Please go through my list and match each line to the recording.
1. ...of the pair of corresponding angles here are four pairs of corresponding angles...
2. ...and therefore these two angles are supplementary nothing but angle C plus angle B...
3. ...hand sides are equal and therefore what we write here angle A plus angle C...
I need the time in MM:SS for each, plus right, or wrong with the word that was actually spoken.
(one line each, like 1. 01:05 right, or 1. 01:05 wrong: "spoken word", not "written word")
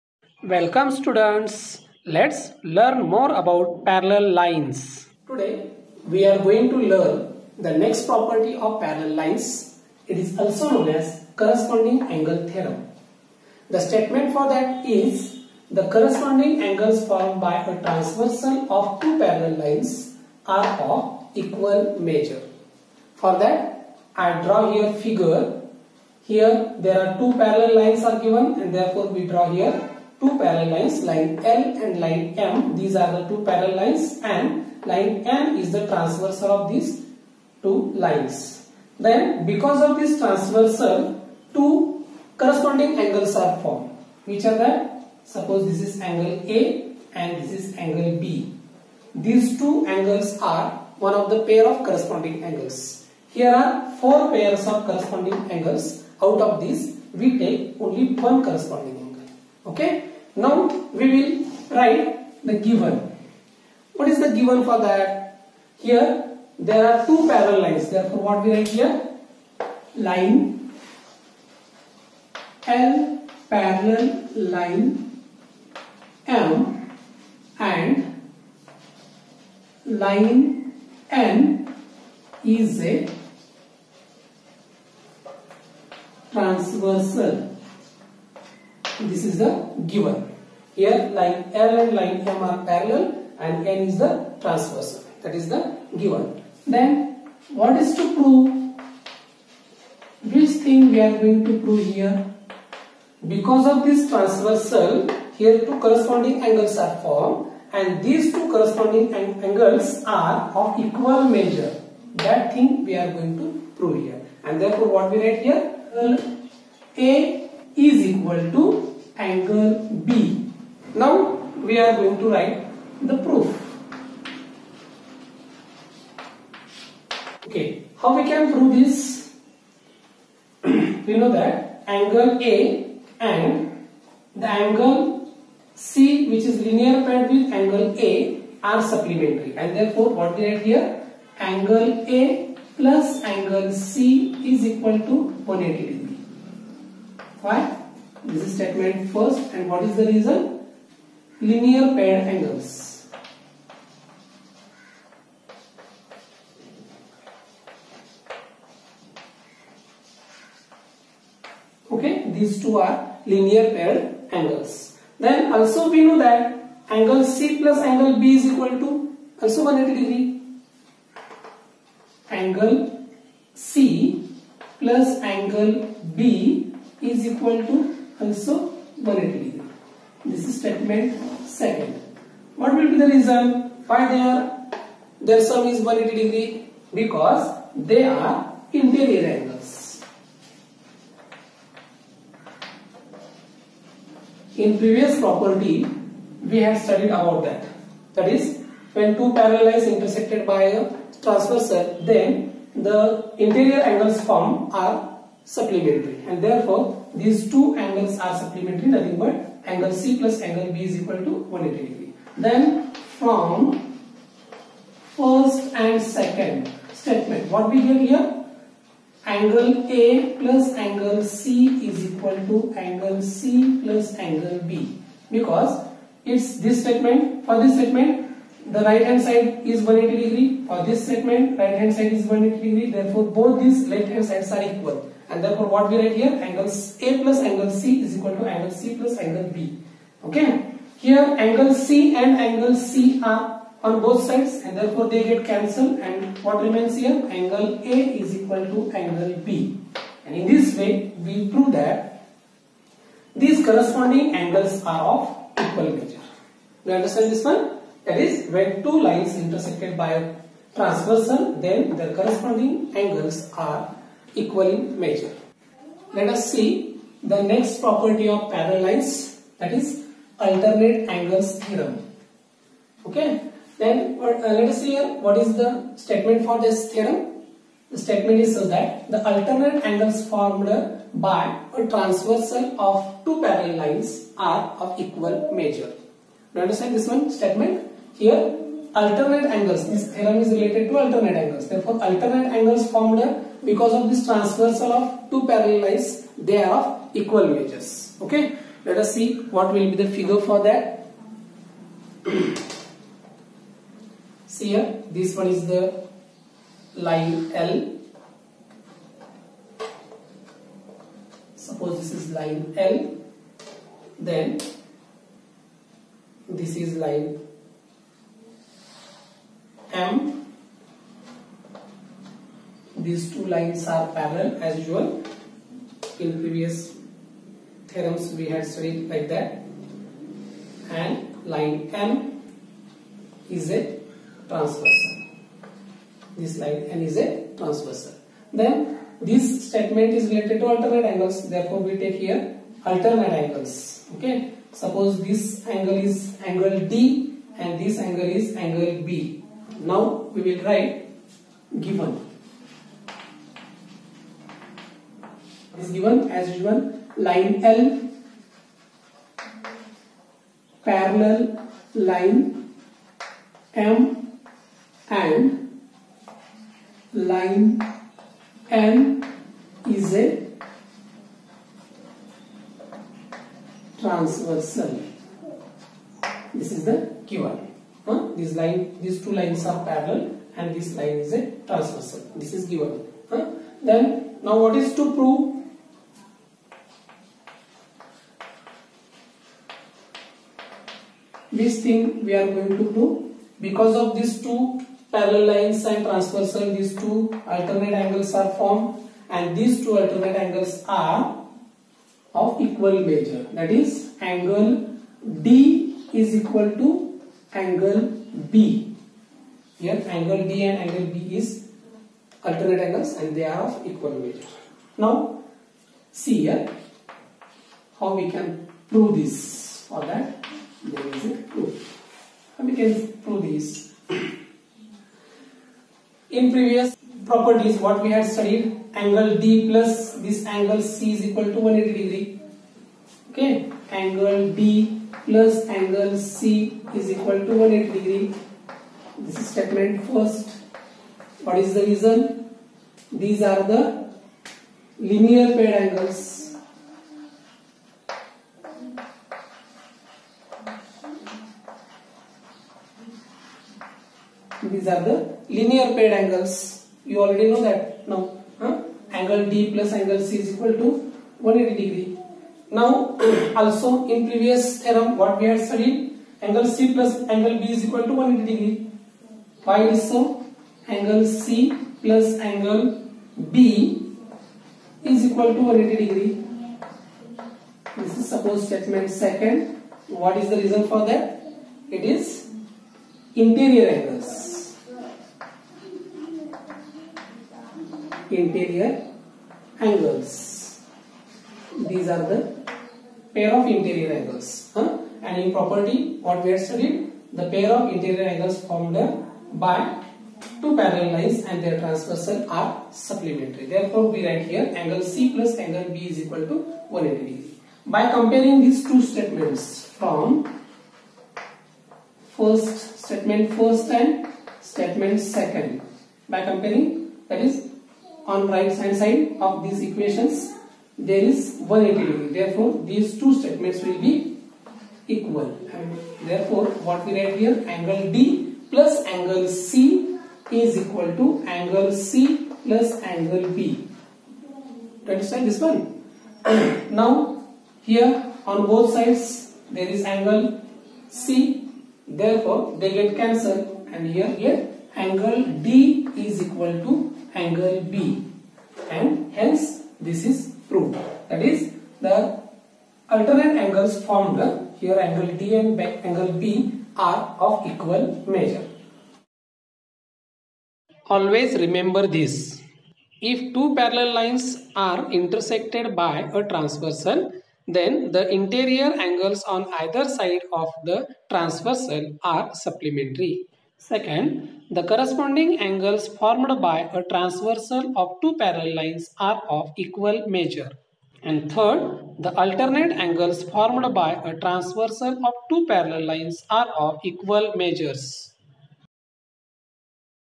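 1. 00:51 right
2. 03:26 right
3. 03:54 right.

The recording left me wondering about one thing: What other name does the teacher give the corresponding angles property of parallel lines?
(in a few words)
corresponding angle theorem.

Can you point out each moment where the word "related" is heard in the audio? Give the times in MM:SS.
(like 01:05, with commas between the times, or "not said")
04:50, 05:40.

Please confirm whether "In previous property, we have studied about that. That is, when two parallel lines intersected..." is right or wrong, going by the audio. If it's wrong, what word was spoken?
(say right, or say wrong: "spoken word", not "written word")
right.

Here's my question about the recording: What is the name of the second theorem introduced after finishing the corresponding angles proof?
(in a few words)
alternate angles theorem.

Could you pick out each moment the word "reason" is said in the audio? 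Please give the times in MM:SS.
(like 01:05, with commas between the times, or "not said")
02:30, 03:03, 07:21, 08:00.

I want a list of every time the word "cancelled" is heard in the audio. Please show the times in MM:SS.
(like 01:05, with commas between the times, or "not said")
04:05, 09:03.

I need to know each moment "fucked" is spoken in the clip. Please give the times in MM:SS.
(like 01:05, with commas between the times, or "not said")
not said.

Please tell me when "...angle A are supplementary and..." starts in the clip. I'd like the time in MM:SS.
02:17.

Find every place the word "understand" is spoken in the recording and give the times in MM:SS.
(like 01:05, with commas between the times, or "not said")
04:16, 04:46, 08:55.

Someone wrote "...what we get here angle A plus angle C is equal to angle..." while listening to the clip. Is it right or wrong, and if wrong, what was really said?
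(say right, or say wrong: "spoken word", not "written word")
right.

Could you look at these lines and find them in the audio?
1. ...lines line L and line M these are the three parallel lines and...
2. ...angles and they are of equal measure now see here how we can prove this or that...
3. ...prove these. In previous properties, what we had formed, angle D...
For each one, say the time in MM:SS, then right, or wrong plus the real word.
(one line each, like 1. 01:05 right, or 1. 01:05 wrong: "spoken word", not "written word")
1. 00:30 wrong: "two", not "three"
2. 06:52 right
3. 07:03 wrong: "studied", not "formed".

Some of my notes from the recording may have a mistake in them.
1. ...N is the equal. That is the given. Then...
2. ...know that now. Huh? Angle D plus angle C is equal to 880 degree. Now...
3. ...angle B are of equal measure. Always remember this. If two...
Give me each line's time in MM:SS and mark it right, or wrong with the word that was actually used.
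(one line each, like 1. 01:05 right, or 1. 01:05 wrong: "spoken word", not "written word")
1. 01:33 wrong: "transversal", not "equal"
2. 07:37 wrong: "180", not "880"
3. 09:15 right.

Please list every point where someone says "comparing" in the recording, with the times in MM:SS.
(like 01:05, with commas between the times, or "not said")
08:28, 08:36.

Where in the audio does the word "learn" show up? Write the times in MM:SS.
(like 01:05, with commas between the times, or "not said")
00:02, 00:06.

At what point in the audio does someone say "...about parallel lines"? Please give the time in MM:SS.
00:03.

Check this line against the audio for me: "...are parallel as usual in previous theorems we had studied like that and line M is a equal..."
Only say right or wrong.
wrong.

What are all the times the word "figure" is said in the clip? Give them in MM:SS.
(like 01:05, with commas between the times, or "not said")
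00:24, 05:00.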